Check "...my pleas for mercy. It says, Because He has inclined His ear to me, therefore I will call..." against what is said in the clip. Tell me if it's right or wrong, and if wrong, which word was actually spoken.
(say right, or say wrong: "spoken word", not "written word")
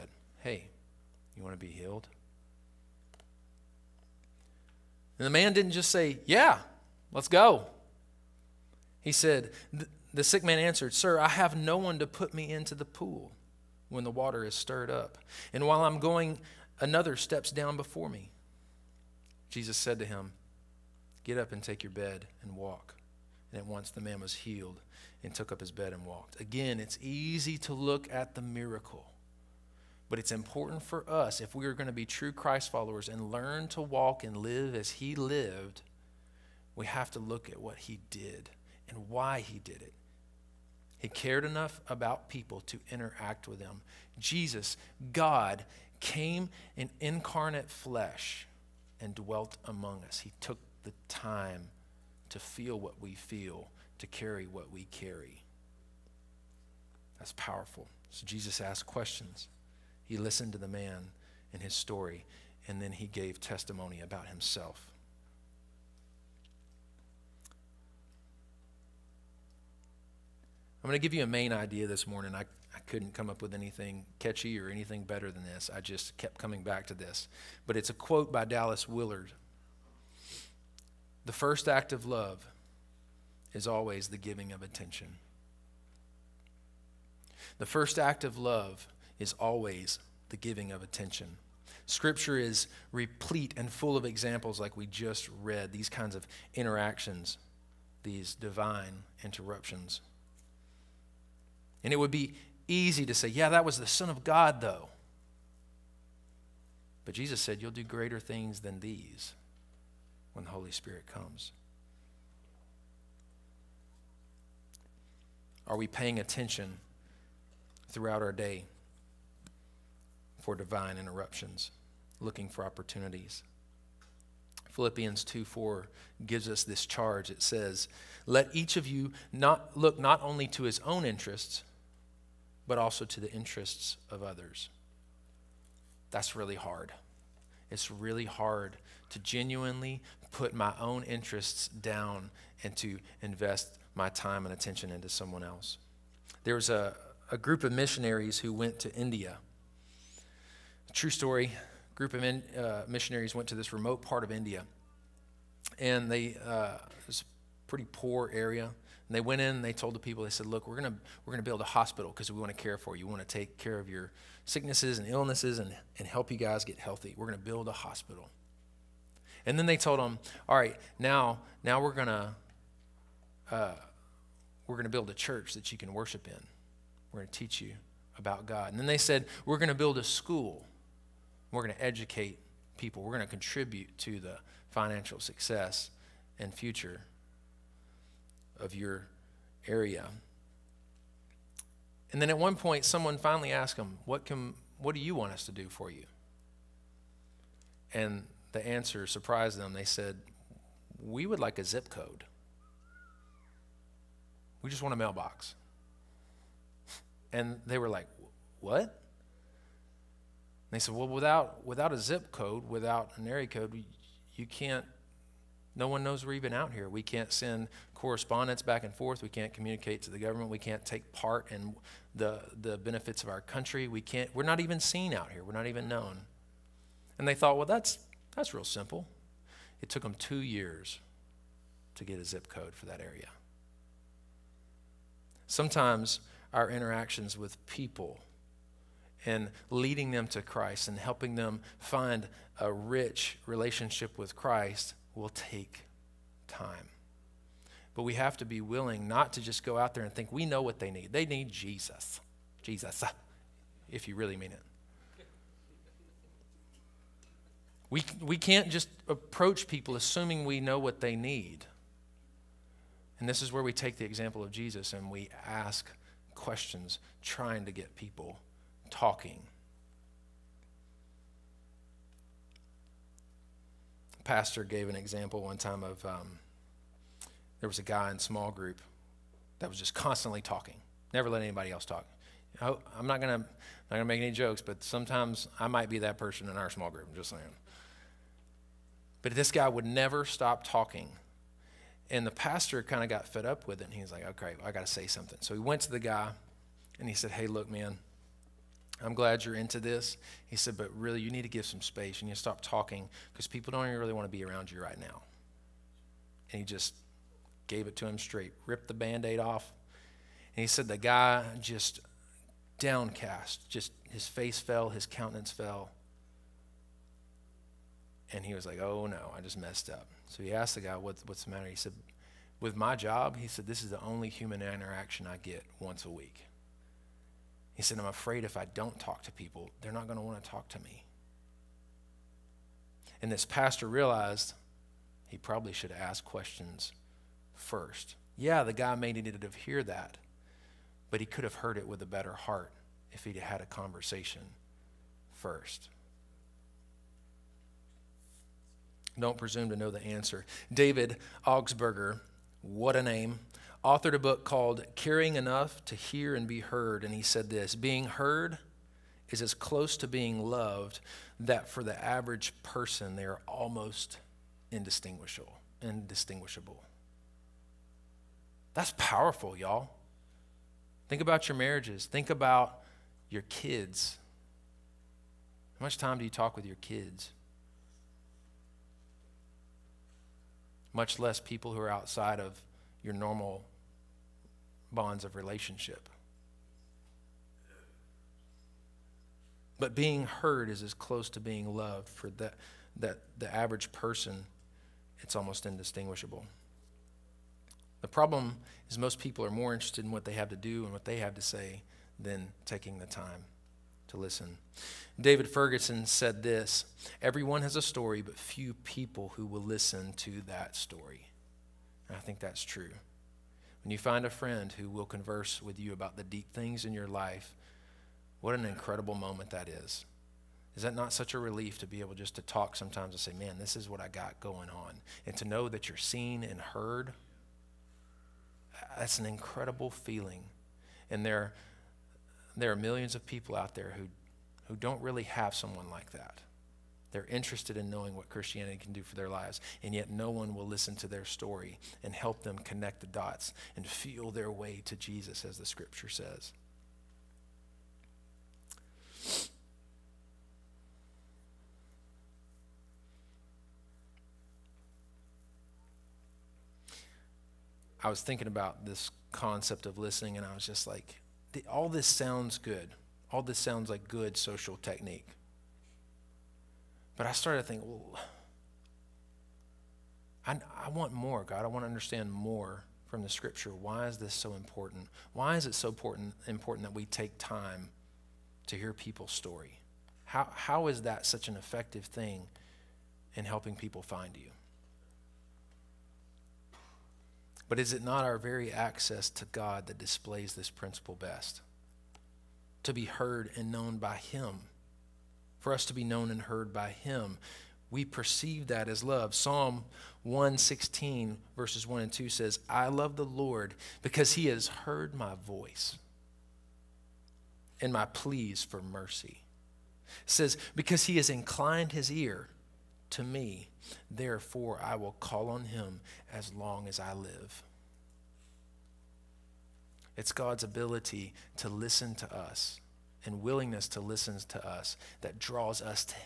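right.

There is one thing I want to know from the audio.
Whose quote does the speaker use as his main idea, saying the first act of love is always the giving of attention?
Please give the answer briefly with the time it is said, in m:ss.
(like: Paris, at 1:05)
Dallas Willard, at 1:18.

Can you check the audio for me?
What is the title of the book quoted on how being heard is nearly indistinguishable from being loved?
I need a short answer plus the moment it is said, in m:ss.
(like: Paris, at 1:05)
Caring Enough to Hear and Be Heard, at 5:54.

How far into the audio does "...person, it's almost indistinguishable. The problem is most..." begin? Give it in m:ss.
6:33.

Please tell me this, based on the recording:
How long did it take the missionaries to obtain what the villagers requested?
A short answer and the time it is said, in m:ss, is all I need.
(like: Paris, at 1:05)
2 years, at 3:50.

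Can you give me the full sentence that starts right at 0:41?
He cared enough about people to interact with them.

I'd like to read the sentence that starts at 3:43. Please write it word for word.
We can't, we're not even seen out here.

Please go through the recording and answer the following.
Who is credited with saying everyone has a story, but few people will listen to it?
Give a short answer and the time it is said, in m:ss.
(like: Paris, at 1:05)
David Ferguson, at 6:45.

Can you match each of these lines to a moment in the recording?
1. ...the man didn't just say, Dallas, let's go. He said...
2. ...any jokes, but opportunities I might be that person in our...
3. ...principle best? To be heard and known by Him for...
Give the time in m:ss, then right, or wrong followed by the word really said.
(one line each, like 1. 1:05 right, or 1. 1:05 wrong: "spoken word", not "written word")
1. 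0:05 wrong: "Yeah", not "Dallas"
2. 4:44 wrong: "sometimes", not "opportunities"
3. 8:10 right.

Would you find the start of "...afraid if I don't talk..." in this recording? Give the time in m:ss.
5:28.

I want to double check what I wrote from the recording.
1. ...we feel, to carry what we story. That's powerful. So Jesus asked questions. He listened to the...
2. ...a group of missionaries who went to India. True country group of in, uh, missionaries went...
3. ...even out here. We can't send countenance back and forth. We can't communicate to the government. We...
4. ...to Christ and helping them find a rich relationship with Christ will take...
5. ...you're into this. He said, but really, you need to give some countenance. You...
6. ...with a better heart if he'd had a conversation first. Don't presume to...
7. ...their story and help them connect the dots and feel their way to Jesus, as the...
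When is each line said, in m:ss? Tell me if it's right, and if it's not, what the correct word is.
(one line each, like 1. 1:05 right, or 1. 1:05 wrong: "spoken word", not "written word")
1. 0:53 wrong: "carry", not "story"
2. 2:27 wrong: "story", not "country"
3. 3:36 wrong: "correspondence", not "countenance"
4. 4:00 right
5. 4:59 wrong: "space", not "countenance"
6. 5:41 right
7. 7:21 right.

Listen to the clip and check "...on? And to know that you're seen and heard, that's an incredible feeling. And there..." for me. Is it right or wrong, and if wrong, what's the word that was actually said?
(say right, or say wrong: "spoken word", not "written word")
right.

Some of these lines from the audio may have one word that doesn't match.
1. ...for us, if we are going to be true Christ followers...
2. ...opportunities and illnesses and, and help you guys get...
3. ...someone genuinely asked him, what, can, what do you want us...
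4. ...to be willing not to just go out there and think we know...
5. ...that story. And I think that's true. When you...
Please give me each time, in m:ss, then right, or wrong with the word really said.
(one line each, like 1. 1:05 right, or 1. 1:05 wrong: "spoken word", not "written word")
1. 0:30 right
2. 2:44 wrong: "sicknesses", not "opportunities"
3. 3:12 wrong: "finally", not "genuinely"
4. 4:08 right
5. 6:50 right.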